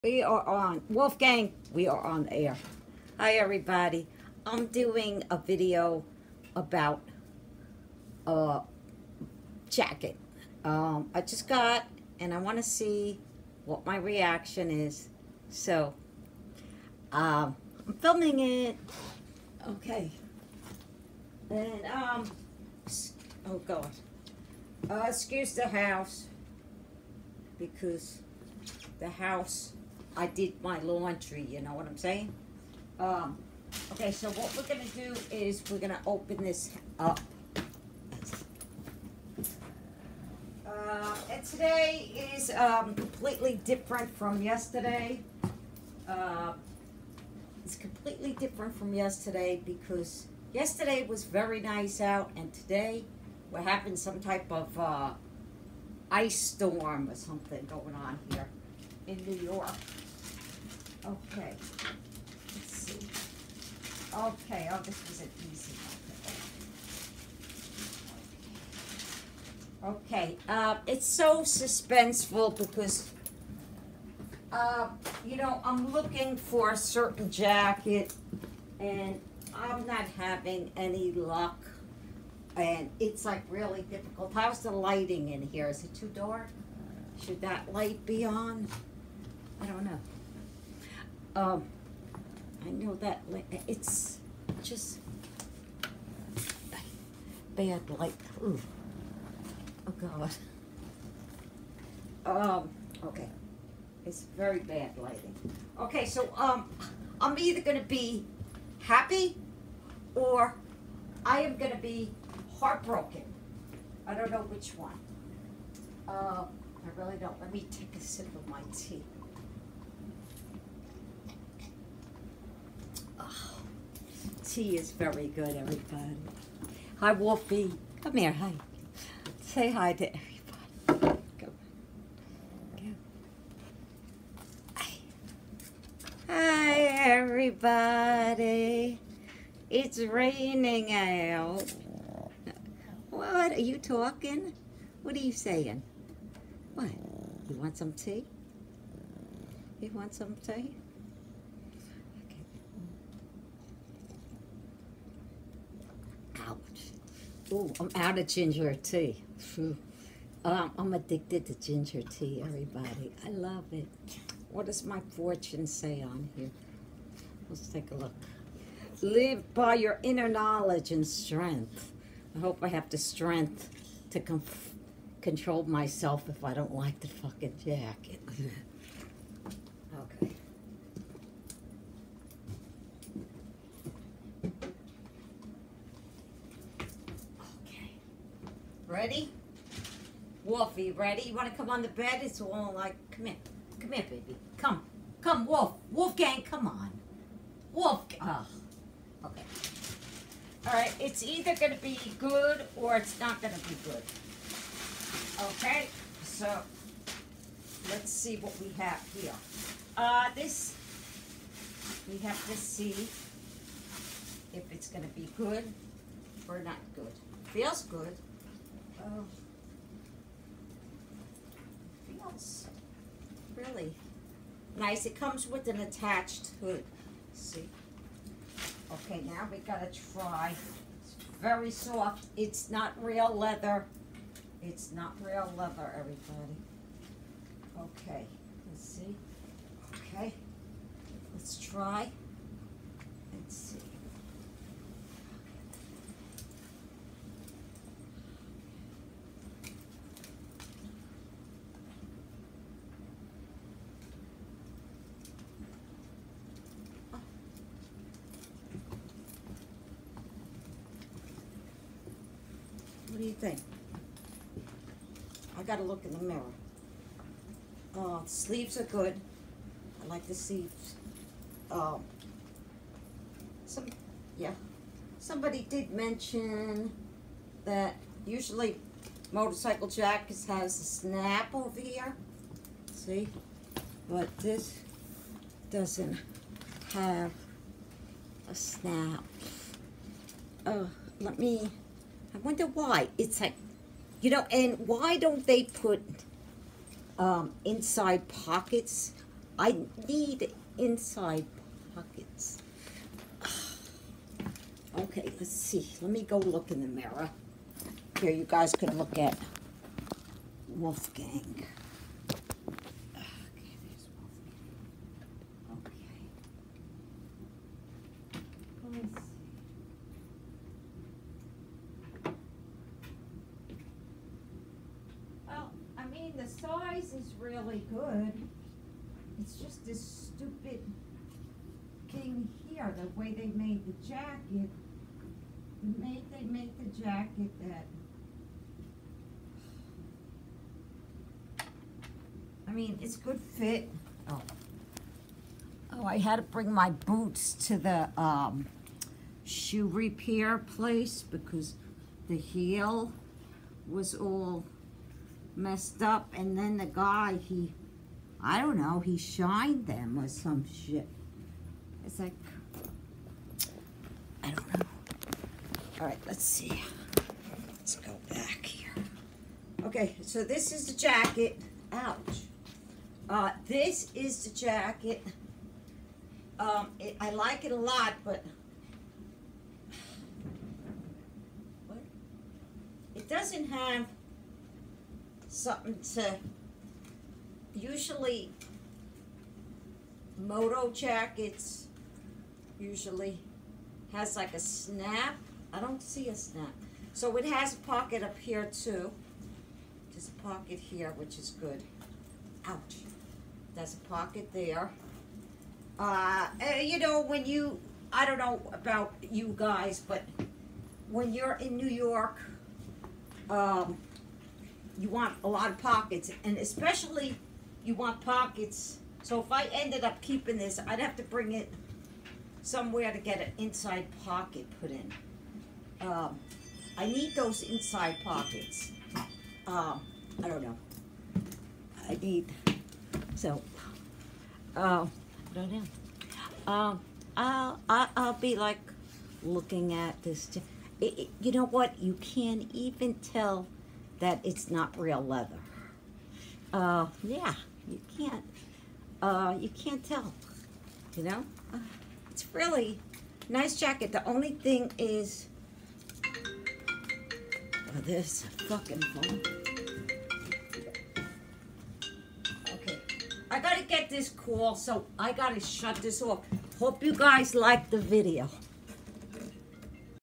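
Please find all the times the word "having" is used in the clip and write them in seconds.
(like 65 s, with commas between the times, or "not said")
53 s, 80 s.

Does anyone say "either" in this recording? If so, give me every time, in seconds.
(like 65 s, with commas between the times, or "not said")
107 s, 201 s.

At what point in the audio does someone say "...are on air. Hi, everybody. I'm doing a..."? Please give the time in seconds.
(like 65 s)
1 s.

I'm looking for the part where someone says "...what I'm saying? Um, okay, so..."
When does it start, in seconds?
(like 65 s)
31 s.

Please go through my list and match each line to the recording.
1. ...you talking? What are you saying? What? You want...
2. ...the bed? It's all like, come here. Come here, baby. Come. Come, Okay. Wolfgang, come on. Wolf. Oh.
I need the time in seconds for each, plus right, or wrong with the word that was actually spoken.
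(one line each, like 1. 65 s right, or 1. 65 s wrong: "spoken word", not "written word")
1. 143 s right
2. 191 s wrong: "Wolf", not "Okay".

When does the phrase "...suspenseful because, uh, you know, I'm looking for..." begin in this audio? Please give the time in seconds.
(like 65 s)
71 s.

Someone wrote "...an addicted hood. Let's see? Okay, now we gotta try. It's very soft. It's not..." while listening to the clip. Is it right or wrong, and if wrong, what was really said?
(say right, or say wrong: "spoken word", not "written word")
wrong: "attached", not "addicted".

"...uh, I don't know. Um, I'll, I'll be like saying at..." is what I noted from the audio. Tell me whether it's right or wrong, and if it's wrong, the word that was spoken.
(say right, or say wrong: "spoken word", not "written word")
wrong: "looking", not "saying".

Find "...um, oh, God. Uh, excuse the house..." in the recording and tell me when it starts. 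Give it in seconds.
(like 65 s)
21 s.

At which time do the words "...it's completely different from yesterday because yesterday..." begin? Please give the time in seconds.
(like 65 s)
47 s.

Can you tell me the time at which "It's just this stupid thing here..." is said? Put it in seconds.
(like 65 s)
329 s.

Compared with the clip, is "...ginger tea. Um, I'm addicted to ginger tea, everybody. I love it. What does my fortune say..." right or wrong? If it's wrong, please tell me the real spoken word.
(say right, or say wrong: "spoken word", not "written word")
right.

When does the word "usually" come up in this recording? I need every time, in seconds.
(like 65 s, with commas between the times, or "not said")
278 s, 387 s, 392 s.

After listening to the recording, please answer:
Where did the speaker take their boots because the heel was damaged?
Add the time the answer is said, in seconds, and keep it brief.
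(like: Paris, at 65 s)
Shoe repair place, at 349 s.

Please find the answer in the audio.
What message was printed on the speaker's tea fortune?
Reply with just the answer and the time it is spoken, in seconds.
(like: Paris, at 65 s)
Live by your inner knowledge and strength, at 169 s.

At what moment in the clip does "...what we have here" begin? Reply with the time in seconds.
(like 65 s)
208 s.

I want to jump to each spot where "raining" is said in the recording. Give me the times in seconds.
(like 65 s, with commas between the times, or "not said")
139 s.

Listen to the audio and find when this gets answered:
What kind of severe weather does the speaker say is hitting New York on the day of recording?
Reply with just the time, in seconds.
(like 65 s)
56 s.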